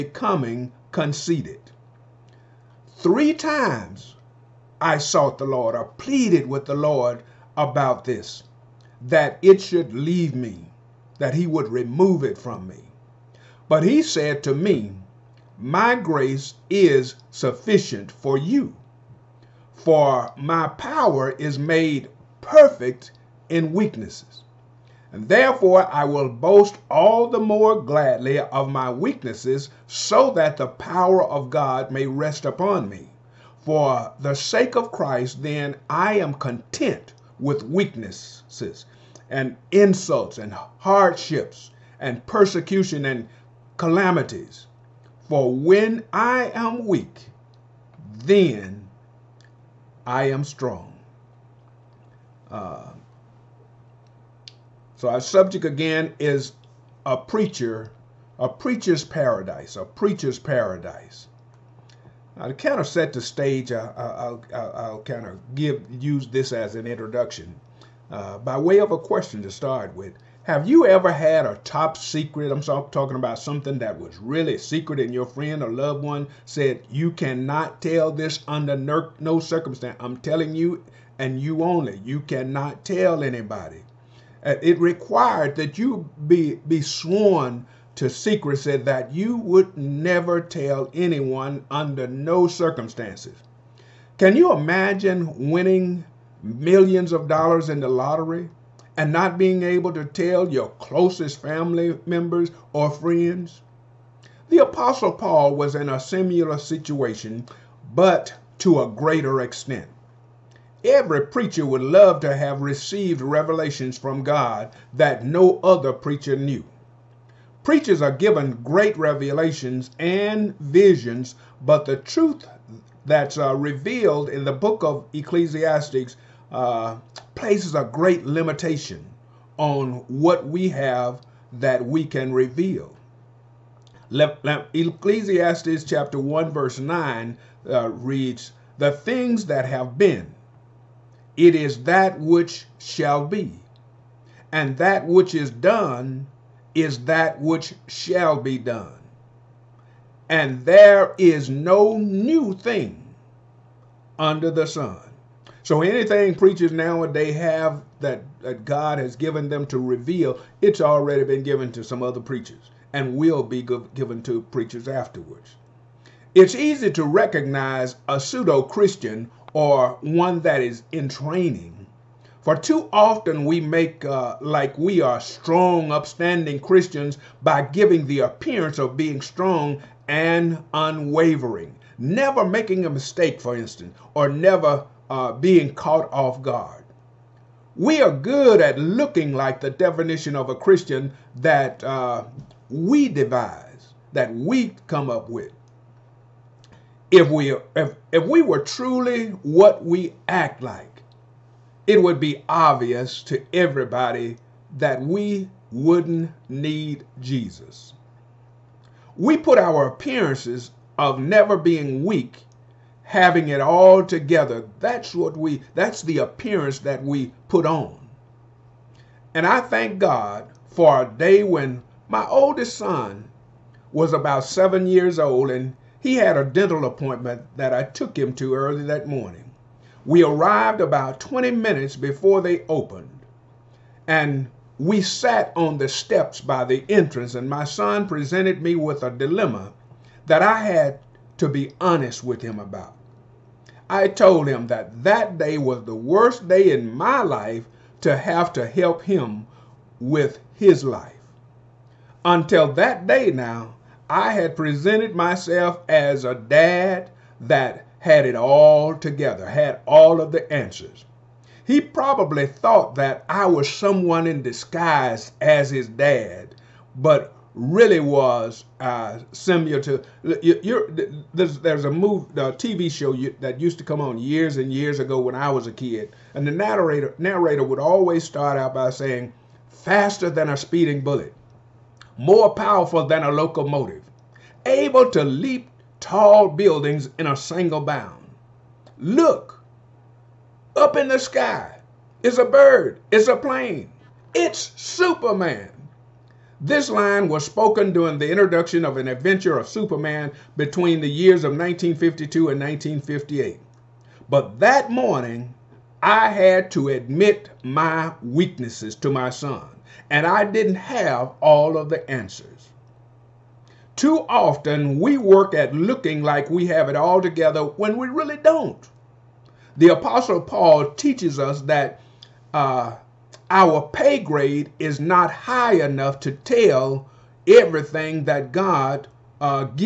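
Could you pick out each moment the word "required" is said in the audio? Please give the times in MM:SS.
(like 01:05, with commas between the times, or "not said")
01:24.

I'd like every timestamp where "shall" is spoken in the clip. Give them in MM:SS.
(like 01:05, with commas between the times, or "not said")
02:22, 02:27.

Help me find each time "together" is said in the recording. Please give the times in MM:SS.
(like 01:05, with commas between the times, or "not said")
03:34, 04:18, 05:17.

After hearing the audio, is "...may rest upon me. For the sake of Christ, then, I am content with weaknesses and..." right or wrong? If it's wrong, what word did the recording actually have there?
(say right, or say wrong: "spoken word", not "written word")
right.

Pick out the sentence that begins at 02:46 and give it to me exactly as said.
It's easy to recognize a pseudo Christian or one that is in training.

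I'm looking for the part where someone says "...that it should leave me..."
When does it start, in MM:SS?
00:09.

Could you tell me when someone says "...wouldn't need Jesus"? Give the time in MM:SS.
03:25.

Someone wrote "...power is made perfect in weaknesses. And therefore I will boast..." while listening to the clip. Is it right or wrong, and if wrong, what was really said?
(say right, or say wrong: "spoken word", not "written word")
right.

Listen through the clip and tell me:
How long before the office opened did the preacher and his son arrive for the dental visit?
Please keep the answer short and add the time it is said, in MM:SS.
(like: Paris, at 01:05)
20 minutes, at 03:51.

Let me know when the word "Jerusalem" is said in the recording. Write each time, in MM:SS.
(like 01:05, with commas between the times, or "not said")
not said.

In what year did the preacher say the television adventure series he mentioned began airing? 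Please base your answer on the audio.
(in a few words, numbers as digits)
1952.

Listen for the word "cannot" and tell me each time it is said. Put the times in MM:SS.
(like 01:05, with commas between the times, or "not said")
01:17, 01:22.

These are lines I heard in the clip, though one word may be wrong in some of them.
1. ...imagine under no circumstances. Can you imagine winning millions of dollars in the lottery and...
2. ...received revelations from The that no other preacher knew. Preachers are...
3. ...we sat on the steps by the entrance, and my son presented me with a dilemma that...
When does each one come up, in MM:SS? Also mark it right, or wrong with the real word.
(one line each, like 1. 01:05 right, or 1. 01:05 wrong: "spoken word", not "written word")
1. 01:30 wrong: "anyone", not "imagine"
2. 01:52 wrong: "God", not "The"
3. 03:54 right.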